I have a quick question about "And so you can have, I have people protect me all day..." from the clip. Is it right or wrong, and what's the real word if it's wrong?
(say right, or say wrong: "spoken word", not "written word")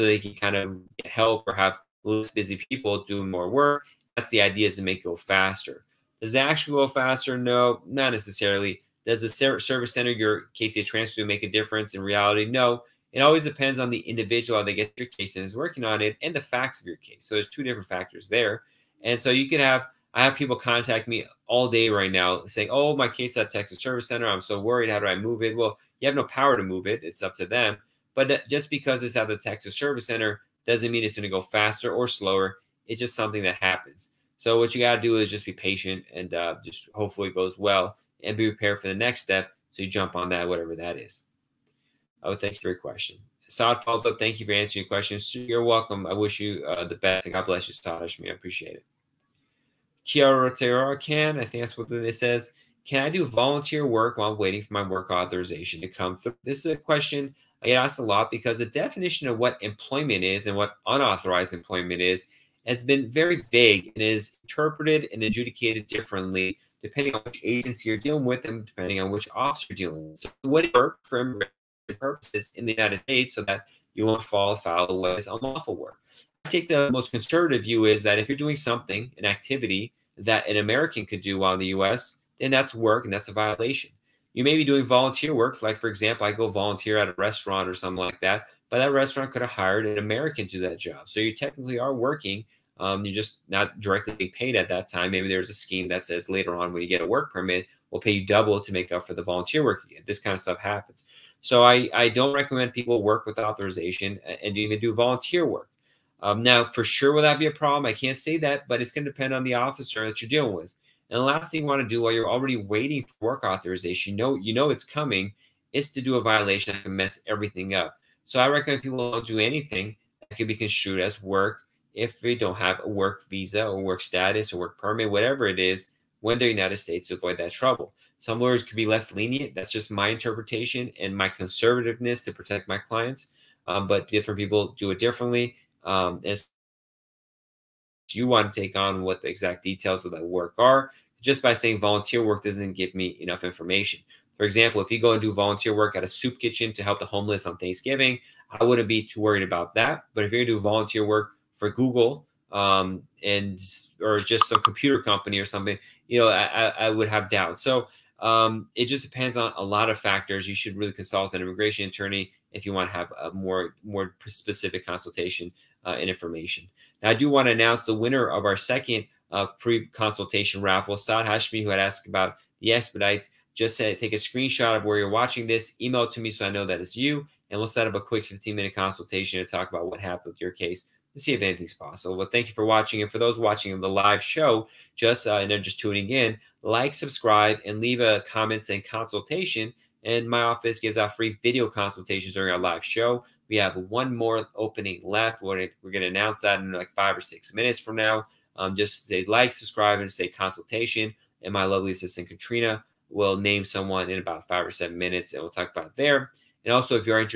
wrong: "contact", not "protect".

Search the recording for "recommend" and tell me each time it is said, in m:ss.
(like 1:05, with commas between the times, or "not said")
1:42, 1:58.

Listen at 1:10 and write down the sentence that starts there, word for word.
So what work for immigration purposes in the United States so that you won't fall foul of what is unlawful work.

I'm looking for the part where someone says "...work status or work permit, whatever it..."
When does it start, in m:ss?
2:03.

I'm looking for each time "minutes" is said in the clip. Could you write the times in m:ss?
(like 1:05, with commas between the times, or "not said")
2:58, 3:17, 3:24.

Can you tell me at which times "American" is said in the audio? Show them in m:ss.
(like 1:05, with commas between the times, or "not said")
1:20, 1:29.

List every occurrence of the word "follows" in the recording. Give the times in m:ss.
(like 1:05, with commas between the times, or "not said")
0:43.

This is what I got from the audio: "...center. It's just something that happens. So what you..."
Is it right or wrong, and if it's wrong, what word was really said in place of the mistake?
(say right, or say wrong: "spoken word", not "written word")
wrong: "slower", not "center".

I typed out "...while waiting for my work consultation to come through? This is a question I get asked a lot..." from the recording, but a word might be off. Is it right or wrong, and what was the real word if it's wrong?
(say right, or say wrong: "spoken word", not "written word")
wrong: "authorization", not "consultation".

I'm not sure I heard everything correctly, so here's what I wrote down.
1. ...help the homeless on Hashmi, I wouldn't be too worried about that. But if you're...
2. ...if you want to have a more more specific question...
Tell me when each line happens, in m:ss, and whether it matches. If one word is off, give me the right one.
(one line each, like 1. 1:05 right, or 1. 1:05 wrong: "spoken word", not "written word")
1. 2:26 wrong: "Thanksgiving", not "Hashmi"
2. 2:42 wrong: "consultation", not "question".